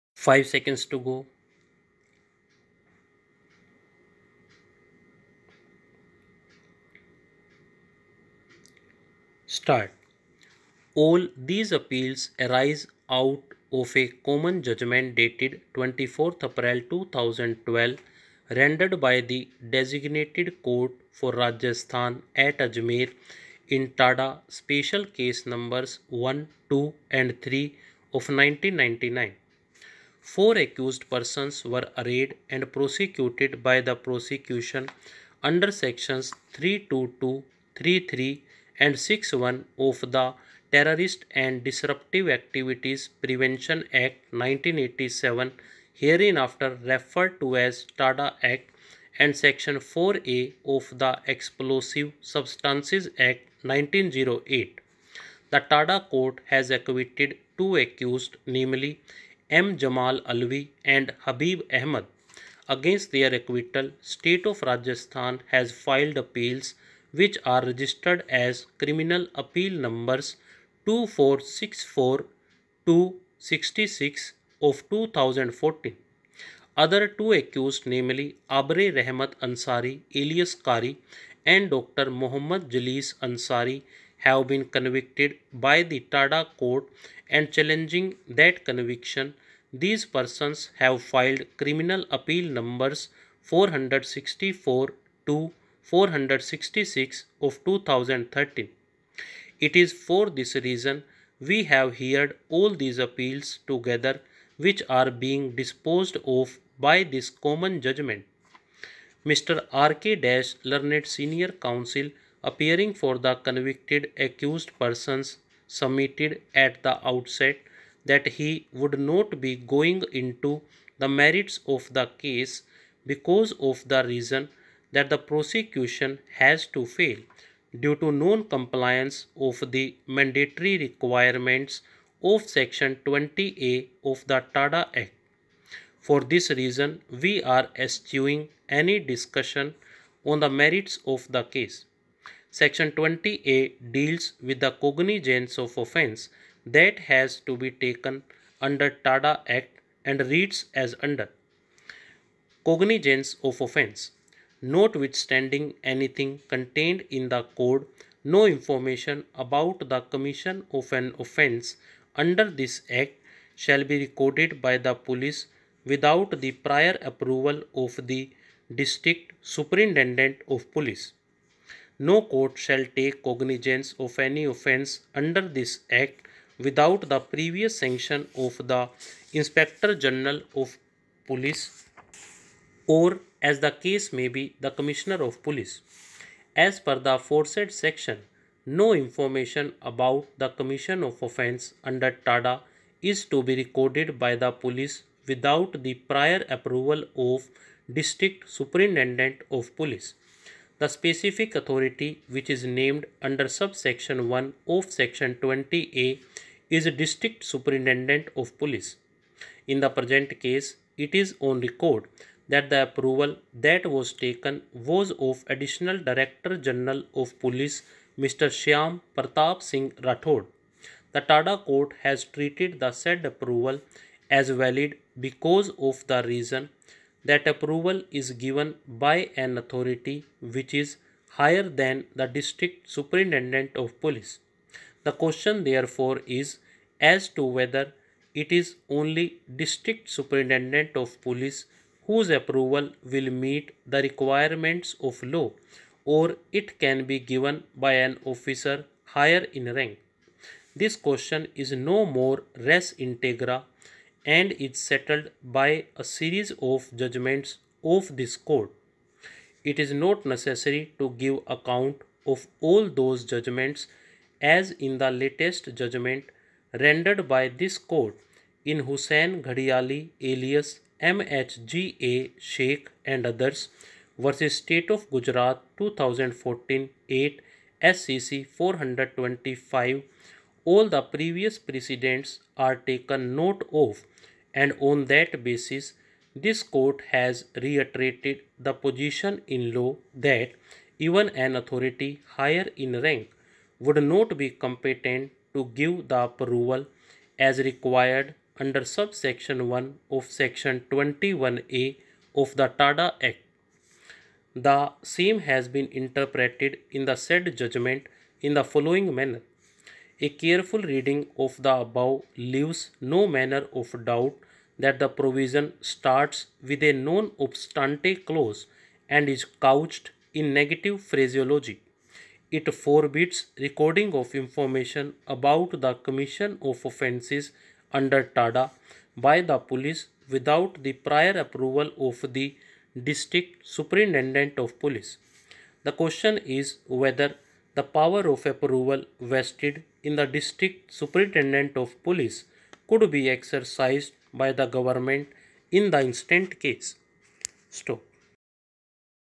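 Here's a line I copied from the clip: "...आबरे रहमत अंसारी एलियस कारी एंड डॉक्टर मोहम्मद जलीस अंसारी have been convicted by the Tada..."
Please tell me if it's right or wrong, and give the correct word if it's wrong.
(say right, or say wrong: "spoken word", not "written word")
right.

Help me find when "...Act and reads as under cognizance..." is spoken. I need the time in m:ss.
2:29.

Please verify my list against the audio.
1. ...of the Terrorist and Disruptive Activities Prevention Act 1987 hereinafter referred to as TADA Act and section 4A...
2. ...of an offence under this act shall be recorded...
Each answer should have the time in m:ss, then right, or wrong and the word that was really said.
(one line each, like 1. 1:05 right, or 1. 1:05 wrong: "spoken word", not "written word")
1. 0:39 right
2. 2:40 right.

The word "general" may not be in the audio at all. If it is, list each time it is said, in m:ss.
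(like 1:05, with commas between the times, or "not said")
3:00, 3:36.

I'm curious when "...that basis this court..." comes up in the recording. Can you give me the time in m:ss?
4:45.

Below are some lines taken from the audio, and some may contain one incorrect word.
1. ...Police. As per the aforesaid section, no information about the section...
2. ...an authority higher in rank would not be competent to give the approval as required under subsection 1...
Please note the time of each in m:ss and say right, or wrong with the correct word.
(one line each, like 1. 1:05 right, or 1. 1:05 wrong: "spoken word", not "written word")
1. 3:05 wrong: "commission", not "section"
2. 4:51 right.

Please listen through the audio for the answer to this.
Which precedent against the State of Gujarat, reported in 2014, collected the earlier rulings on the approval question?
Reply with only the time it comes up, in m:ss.
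4:28.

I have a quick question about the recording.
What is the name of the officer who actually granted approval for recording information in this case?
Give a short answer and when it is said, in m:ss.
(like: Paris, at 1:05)
Shyam Pratap Singh Rathod, at 3:38.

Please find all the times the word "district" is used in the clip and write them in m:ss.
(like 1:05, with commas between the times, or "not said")
2:48, 3:17, 3:27, 3:52, 3:59, 5:33, 5:40.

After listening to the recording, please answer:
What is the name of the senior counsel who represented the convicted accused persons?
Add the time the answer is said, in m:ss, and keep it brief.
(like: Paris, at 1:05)
R.K. Dash, at 1:49.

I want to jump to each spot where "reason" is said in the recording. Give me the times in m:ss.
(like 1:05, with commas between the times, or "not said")
1:40, 2:04, 2:16, 3:46.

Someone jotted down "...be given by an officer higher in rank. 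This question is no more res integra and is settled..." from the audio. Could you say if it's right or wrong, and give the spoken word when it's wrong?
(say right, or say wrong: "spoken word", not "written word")
right.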